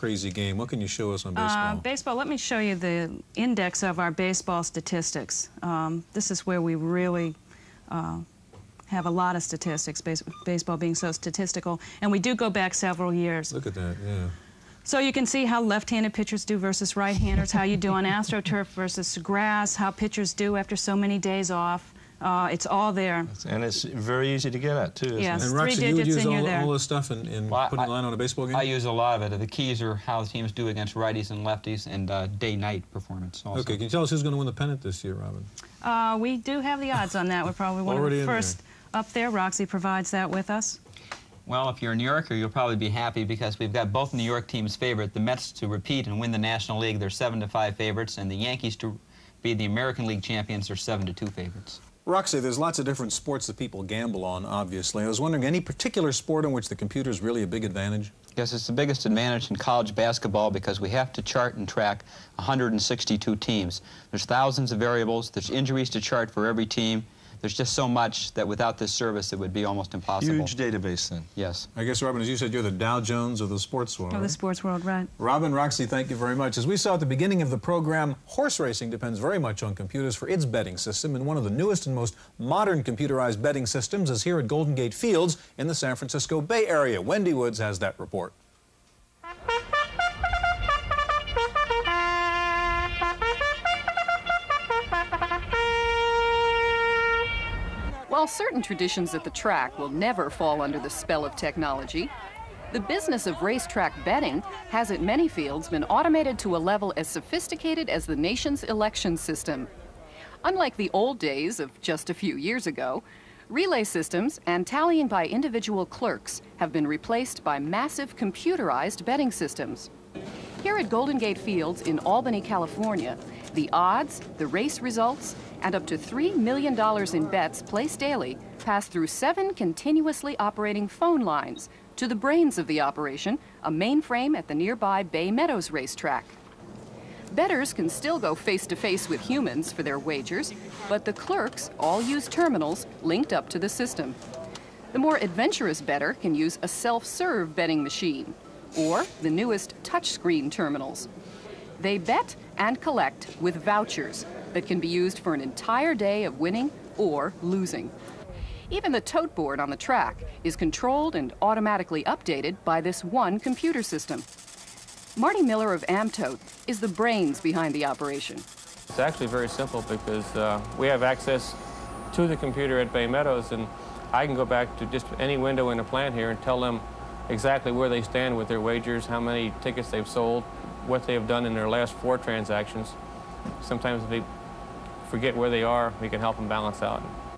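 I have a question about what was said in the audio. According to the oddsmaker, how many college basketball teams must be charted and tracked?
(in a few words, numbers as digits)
162.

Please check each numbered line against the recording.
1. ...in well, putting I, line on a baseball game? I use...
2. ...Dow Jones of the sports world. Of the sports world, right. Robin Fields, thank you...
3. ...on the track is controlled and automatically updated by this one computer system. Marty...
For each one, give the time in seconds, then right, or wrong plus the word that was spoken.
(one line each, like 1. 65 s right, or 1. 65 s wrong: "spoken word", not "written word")
1. 27 s right
2. 72 s wrong: "Roxy", not "Fields"
3. 159 s right.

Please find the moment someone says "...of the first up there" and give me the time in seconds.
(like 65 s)
38 s.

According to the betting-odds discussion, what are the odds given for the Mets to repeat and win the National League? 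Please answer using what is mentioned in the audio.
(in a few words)
7 to 5.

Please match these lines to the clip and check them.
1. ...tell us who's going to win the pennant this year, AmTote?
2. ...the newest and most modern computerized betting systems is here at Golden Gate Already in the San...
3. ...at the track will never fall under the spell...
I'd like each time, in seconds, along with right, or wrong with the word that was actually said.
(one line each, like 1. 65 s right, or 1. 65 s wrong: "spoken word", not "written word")
1. 33 s wrong: "Robin", not "AmTote"
2. 81 s wrong: "Fields", not "Already"
3. 99 s right.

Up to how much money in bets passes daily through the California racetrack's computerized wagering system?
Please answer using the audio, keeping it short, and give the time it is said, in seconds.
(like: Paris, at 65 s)
$3 million, at 125 s.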